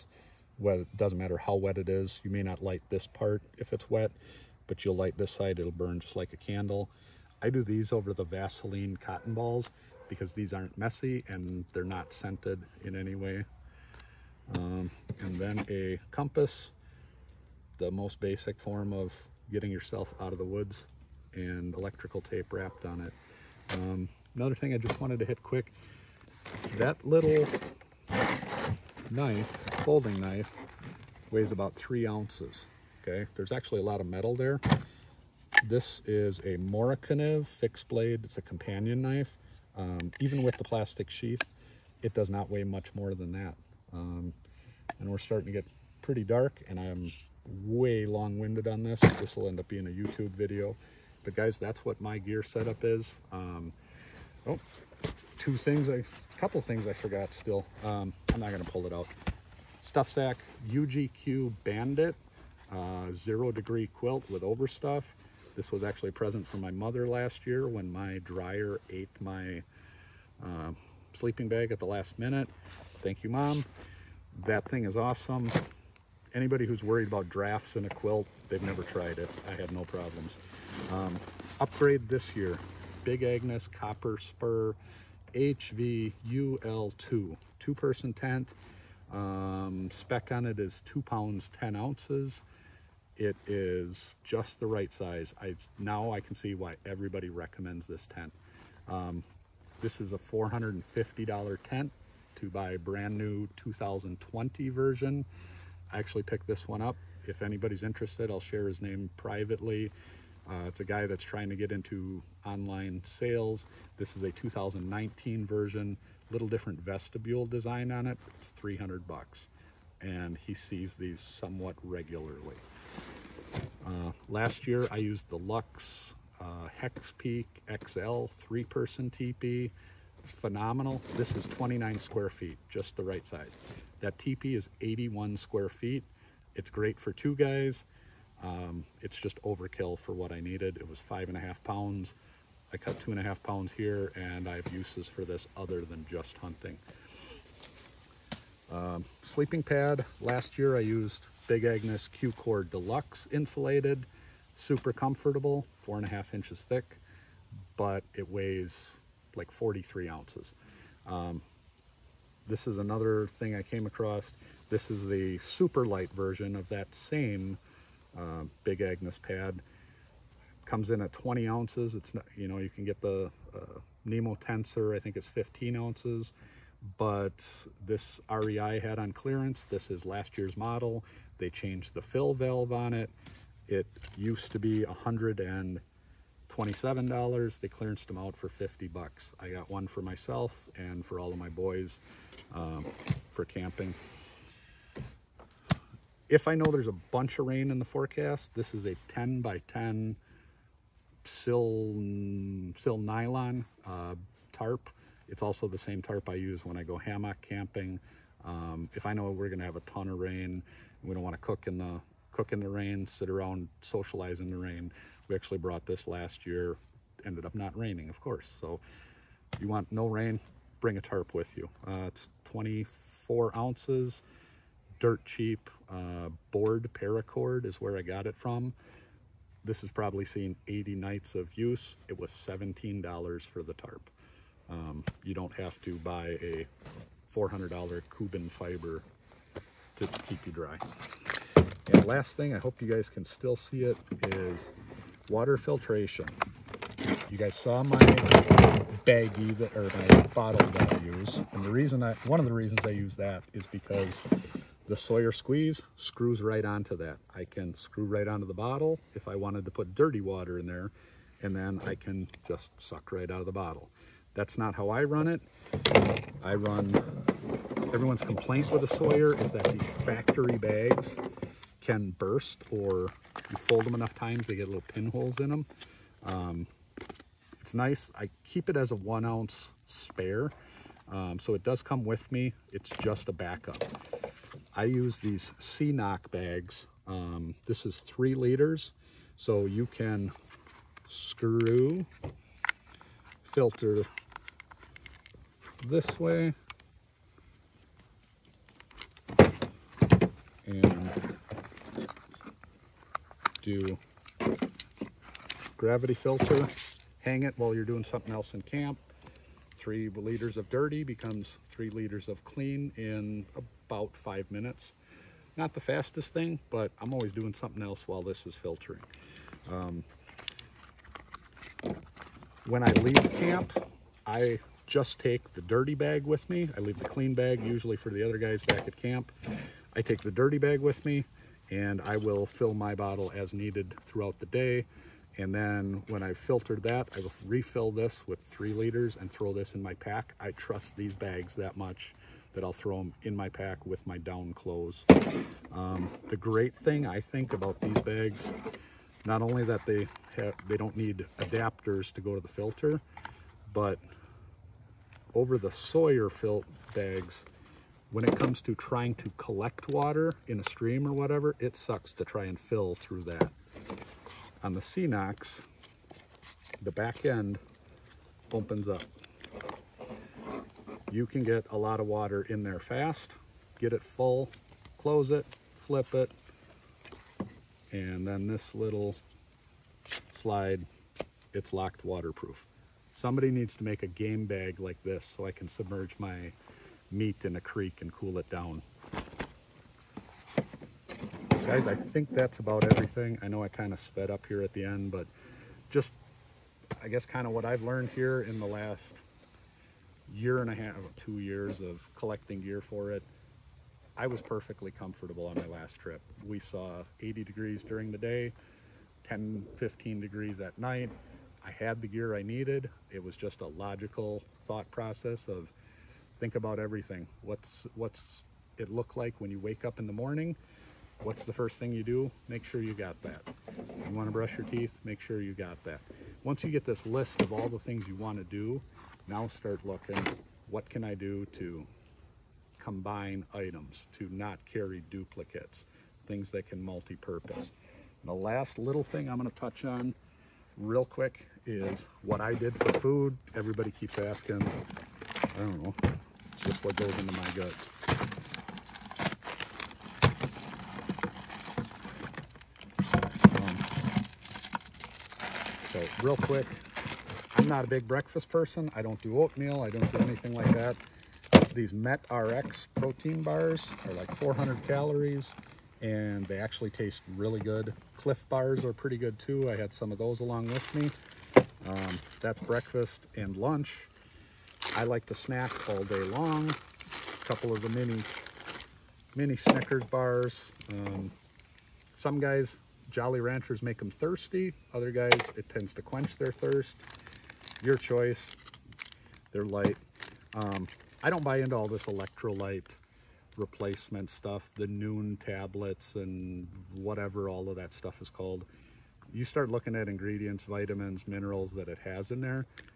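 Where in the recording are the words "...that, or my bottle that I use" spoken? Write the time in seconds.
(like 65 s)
249 s.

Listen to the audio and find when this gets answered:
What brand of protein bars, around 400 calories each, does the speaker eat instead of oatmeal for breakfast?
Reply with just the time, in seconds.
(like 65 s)
461 s.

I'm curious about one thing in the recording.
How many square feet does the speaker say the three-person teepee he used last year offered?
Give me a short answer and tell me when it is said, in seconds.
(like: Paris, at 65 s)
81 square feet, at 134 s.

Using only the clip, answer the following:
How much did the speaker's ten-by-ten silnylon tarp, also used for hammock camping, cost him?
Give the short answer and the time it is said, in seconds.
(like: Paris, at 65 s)
$17, at 232 s.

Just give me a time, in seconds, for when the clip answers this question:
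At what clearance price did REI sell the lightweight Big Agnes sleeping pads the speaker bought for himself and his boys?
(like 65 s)
188 s.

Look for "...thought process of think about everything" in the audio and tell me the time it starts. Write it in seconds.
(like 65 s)
414 s.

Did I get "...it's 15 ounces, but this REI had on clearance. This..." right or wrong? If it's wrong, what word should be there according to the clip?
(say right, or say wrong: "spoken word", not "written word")
right.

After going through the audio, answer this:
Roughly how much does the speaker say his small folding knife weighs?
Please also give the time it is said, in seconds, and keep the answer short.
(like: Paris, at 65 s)
3 ounces, at 31 s.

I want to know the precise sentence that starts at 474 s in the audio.
I like to snack all day long.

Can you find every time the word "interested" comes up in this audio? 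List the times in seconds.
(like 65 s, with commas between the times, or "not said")
107 s.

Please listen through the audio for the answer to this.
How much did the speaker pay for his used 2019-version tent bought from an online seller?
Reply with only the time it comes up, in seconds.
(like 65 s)
118 s.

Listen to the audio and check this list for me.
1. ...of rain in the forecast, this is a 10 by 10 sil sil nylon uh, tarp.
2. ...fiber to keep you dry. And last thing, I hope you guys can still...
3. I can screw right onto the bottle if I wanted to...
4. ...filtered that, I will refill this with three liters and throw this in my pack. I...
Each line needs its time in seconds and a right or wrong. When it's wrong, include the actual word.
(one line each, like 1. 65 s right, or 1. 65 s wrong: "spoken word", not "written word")
1. 197 s right
2. 238 s right
3. 257 s right
4. 336 s right.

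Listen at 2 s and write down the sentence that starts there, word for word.
You may not light this part if it's wet, but you'll light this side, it'll burn just like a candle.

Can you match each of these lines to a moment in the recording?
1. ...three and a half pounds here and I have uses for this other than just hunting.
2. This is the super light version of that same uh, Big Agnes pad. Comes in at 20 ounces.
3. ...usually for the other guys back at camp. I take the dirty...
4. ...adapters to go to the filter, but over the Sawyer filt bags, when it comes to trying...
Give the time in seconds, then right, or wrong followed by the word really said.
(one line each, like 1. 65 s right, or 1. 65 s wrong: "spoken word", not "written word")
1. 142 s wrong: "two", not "three"
2. 164 s right
3. 327 s right
4. 351 s right.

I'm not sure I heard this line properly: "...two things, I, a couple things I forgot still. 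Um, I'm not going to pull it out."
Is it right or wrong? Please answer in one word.
right.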